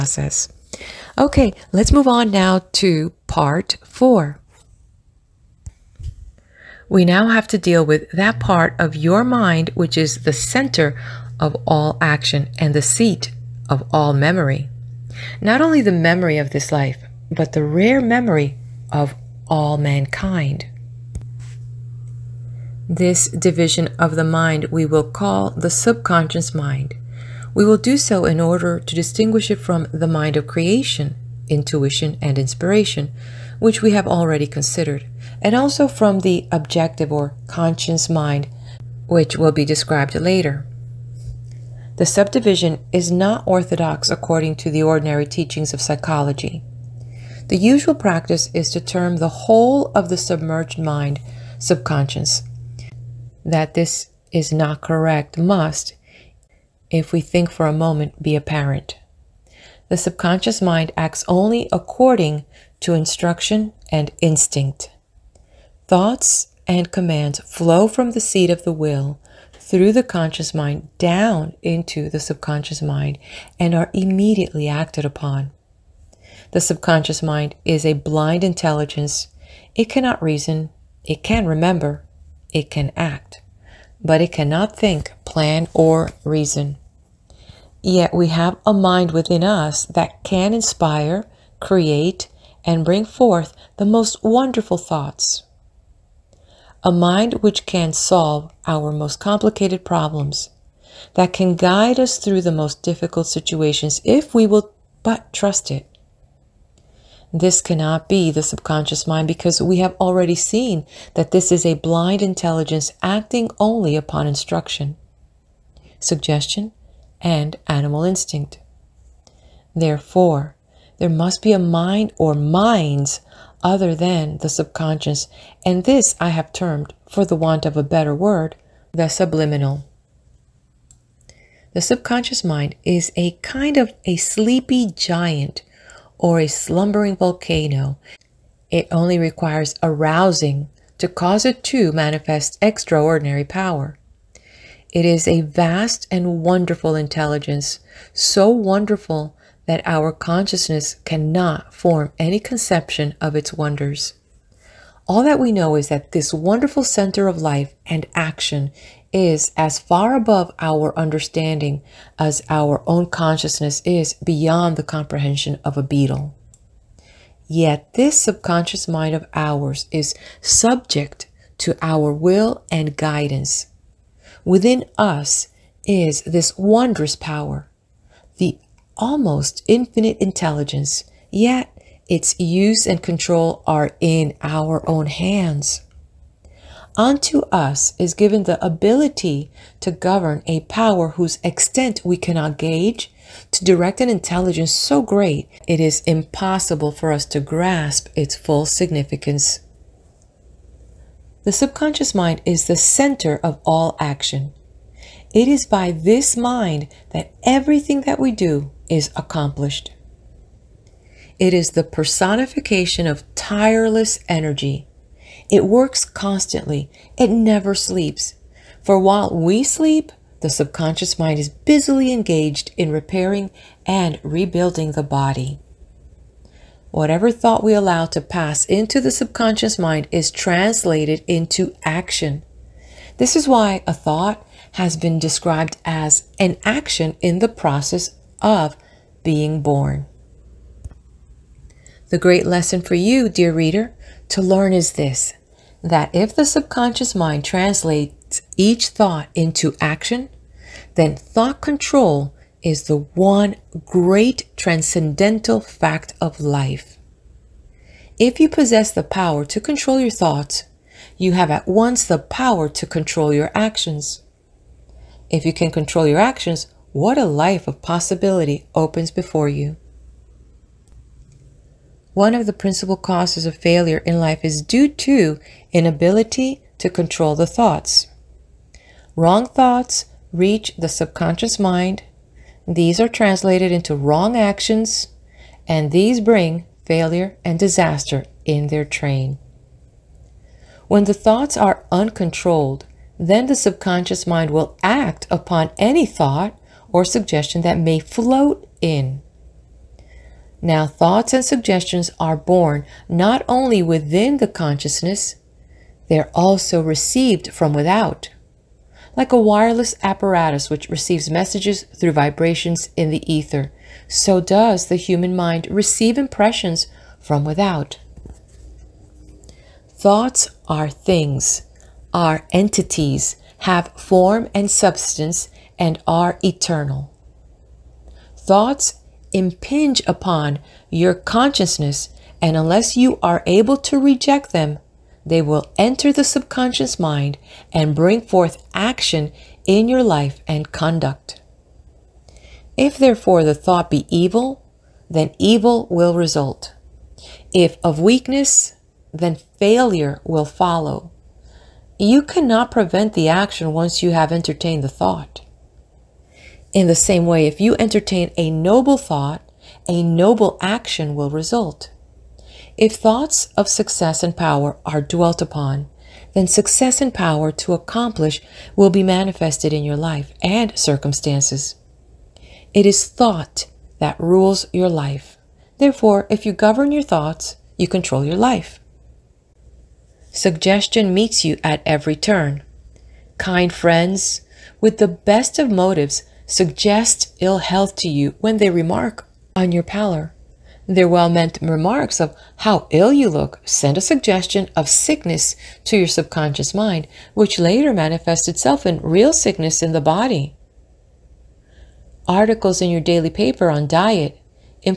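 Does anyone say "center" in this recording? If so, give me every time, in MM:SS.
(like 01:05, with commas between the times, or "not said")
00:10, 02:36, 03:22.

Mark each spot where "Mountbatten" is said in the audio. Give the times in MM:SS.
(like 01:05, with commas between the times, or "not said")
not said.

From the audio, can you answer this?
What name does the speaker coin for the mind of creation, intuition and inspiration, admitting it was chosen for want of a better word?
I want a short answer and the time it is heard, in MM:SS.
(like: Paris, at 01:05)
the subliminal, at 02:08.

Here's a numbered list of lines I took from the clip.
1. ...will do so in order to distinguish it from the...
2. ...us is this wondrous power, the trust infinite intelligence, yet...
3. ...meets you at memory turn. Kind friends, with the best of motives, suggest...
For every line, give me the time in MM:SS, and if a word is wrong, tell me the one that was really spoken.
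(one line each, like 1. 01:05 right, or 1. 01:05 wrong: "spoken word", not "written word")
1. 00:27 right
2. 02:54 wrong: "almost", not "trust"
3. 06:21 wrong: "every", not "memory".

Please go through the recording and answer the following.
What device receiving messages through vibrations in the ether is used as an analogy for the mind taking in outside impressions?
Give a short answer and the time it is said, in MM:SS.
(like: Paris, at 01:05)
wireless apparatus, at 05:09.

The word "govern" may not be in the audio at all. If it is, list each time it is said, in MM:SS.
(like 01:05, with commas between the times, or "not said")
03:09, 06:16.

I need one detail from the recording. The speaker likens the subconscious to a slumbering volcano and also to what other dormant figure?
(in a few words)
a sleepy giant.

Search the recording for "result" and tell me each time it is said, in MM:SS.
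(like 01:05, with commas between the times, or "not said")
05:46, 06:01.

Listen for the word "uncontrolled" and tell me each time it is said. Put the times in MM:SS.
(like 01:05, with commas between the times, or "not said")
04:51.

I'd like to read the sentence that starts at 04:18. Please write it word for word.
If you possess the power to control your thoughts, you have at once the power to control your actions.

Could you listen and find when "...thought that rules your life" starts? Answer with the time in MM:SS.
06:13.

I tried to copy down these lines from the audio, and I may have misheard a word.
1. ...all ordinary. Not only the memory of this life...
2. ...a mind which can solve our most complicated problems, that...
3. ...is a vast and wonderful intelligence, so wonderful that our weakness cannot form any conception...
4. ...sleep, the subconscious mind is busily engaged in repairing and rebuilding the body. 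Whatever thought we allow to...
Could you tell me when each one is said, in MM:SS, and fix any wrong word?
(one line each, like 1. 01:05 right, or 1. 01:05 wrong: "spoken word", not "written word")
1. 00:13 wrong: "memory", not "ordinary"
2. 01:36 right
3. 02:25 wrong: "consciousness", not "weakness"
4. 03:39 right.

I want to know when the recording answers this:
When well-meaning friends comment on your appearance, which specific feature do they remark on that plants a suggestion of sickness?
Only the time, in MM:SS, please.
06:29.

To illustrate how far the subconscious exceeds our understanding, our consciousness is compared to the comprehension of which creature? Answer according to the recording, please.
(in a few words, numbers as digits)
a beetle.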